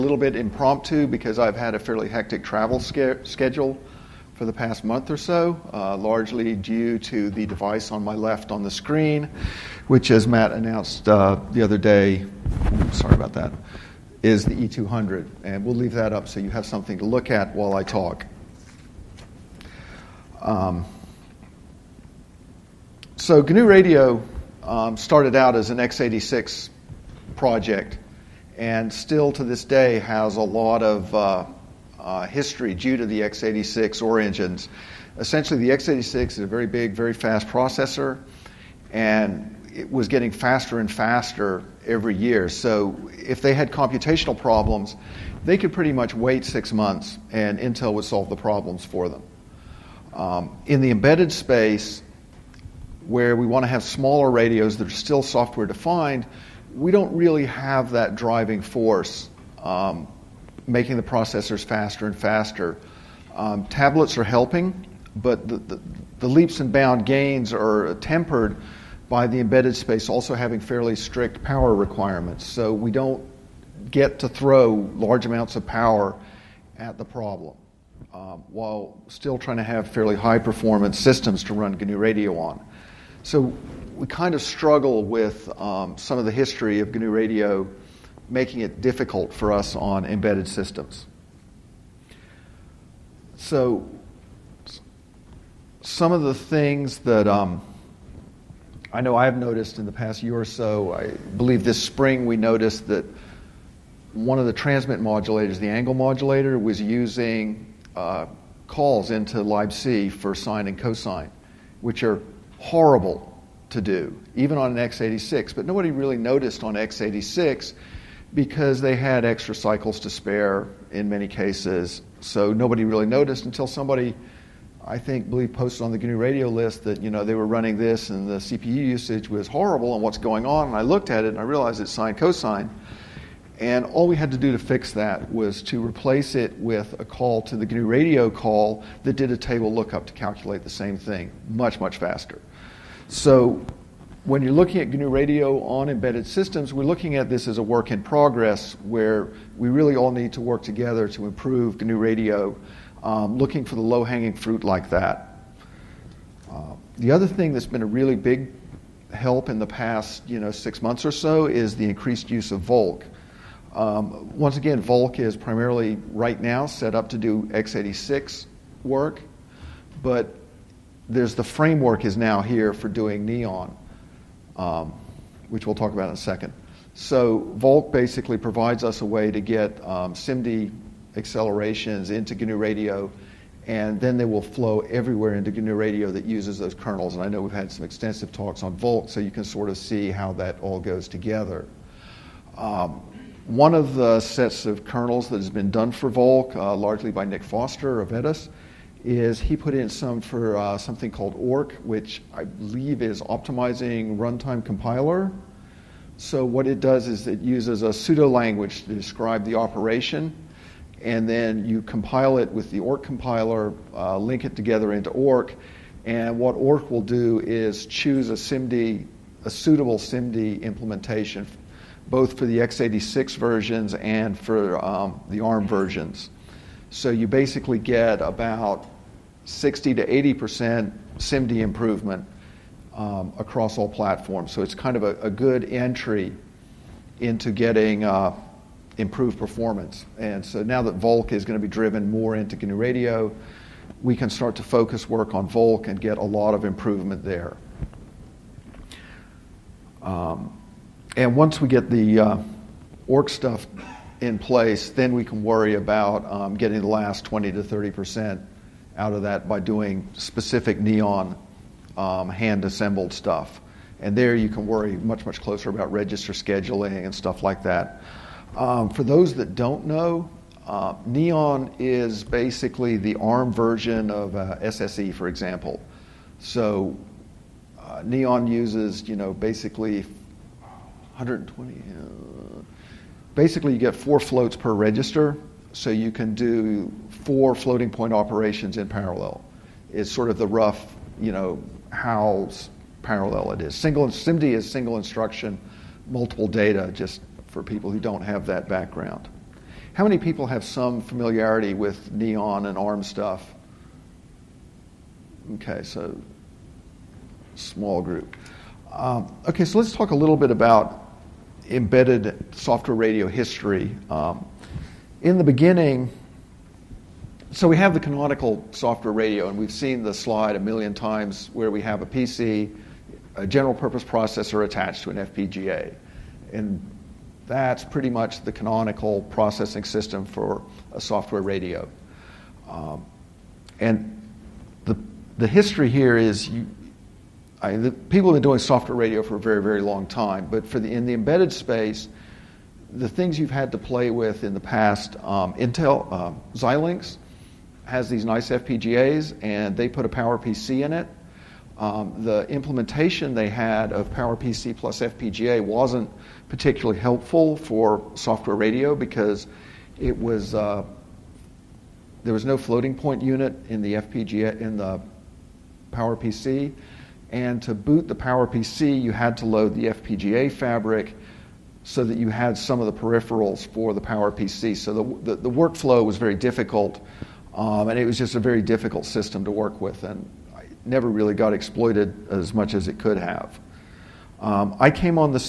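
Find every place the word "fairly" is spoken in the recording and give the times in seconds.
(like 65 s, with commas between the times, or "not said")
1 s, 70 s, 79 s.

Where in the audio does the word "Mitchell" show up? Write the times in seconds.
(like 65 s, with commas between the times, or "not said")
not said.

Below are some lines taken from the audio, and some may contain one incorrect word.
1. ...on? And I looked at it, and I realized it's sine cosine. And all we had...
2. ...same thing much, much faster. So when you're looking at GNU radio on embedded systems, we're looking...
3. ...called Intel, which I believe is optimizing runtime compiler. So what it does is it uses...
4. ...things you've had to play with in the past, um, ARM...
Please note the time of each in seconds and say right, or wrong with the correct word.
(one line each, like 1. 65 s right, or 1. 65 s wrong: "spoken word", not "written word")
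1. 130 s right
2. 140 s right
3. 201 s wrong: "Orc", not "Intel"
4. 343 s wrong: "Intel", not "ARM".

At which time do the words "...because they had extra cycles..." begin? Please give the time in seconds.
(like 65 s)
118 s.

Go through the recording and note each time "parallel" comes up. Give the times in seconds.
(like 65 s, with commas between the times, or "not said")
288 s, 293 s.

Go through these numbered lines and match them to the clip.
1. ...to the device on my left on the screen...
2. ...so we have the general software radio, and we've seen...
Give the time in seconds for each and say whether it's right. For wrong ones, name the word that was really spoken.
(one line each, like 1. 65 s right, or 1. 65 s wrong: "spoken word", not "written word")
1. 7 s right
2. 317 s wrong: "canonical", not "general".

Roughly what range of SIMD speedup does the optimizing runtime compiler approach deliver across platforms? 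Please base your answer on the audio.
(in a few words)
60 to 80 percent.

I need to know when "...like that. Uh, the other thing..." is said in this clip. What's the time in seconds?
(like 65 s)
154 s.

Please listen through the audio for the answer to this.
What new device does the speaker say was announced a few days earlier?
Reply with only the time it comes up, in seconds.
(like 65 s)
14 s.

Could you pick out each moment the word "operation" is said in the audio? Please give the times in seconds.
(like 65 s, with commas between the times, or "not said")
209 s, 288 s.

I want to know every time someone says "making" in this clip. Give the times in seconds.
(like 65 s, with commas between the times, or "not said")
60 s, 88 s.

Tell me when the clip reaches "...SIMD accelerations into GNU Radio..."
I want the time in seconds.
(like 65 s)
180 s.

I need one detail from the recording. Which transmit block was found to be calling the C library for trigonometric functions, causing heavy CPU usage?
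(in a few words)
the angle modulator.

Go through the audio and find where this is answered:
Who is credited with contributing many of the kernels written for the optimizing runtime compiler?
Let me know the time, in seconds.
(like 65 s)
197 s.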